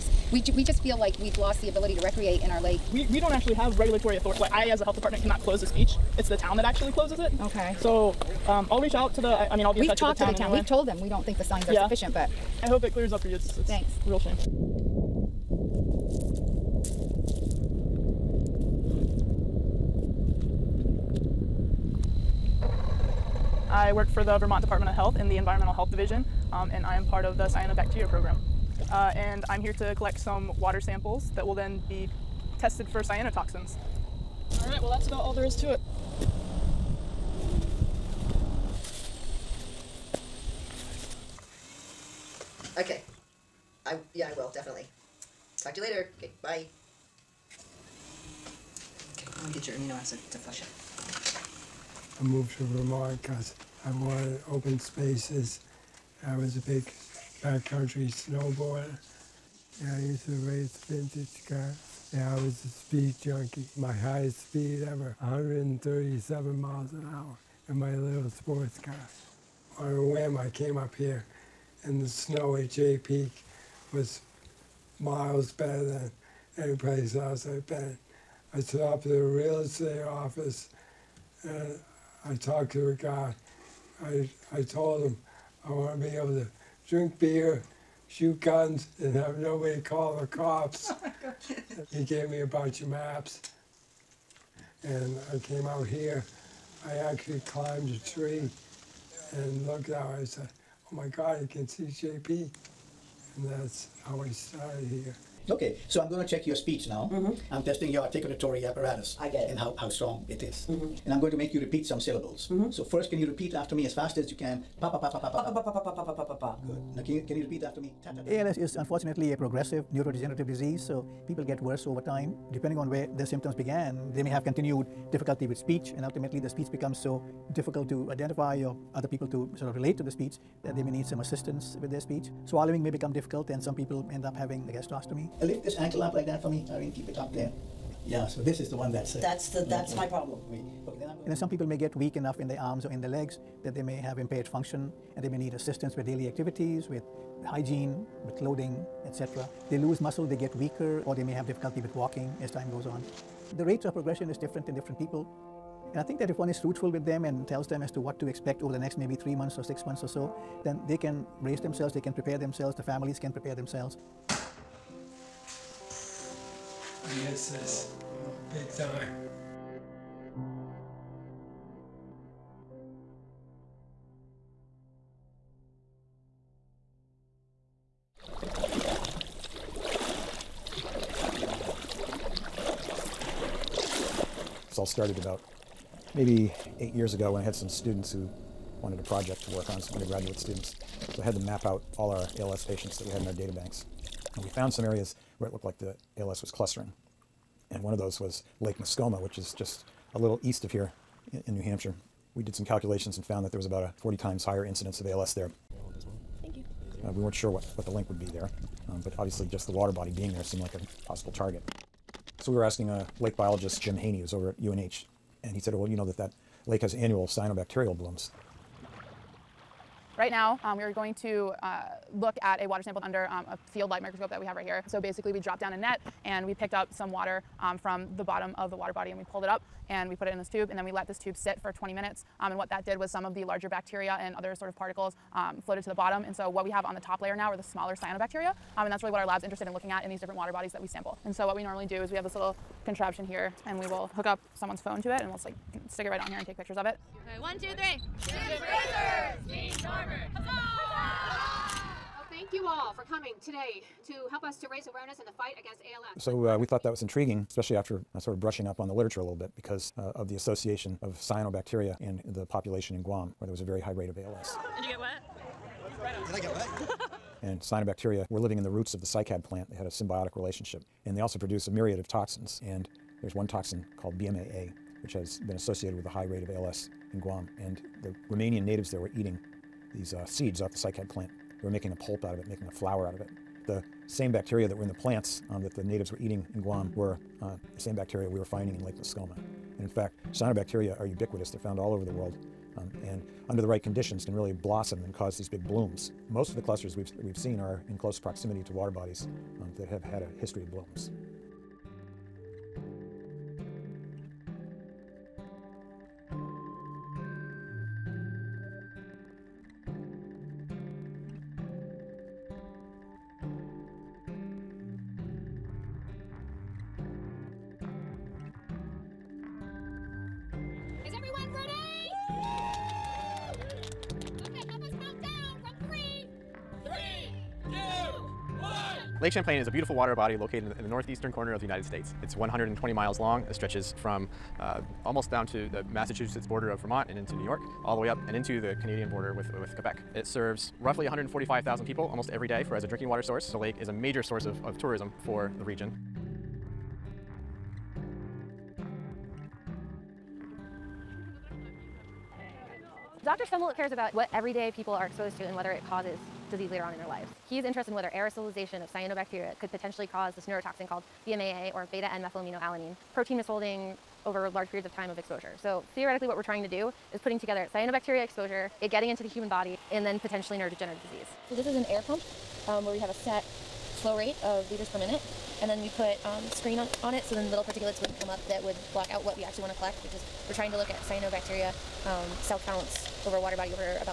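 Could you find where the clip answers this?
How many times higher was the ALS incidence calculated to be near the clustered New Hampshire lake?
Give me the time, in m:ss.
3:23.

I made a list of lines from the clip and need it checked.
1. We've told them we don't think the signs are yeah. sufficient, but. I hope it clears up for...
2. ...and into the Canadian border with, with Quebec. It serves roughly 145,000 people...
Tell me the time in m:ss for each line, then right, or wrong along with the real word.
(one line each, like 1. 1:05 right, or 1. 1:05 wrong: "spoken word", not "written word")
1. 0:10 right
2. 5:38 right.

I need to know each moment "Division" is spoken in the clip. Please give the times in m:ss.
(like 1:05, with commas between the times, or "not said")
0:25.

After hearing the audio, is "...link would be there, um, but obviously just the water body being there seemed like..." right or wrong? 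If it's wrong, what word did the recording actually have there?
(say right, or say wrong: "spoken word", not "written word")
right.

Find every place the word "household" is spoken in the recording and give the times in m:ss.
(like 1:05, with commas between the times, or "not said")
not said.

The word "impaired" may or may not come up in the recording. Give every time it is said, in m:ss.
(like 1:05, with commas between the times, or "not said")
2:24.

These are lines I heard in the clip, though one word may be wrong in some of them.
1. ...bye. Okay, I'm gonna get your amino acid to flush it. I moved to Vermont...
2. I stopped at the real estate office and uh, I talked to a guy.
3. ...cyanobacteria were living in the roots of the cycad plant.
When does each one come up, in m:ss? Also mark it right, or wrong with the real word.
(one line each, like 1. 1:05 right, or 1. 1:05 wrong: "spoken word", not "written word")
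1. 0:46 right
2. 1:18 right
3. 4:27 right.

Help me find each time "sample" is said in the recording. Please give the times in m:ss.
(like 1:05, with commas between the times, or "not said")
0:30, 3:42, 4:00.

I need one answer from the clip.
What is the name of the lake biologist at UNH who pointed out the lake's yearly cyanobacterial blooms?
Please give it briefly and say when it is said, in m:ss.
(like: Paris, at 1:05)
Jim Haney, at 3:33.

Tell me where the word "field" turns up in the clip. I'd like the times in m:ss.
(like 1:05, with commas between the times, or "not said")
3:43.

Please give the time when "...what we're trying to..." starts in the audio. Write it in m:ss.
6:06.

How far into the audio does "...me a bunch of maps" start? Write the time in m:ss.
1:32.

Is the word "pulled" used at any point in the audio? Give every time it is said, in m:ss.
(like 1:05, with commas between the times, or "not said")
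3:49.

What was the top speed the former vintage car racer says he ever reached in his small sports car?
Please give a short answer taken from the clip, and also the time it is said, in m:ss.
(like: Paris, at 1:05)
137 miles an hour, at 1:05.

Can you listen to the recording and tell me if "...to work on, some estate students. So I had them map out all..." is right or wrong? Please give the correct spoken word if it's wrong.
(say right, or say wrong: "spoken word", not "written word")
wrong: "undergraduate", not "estate".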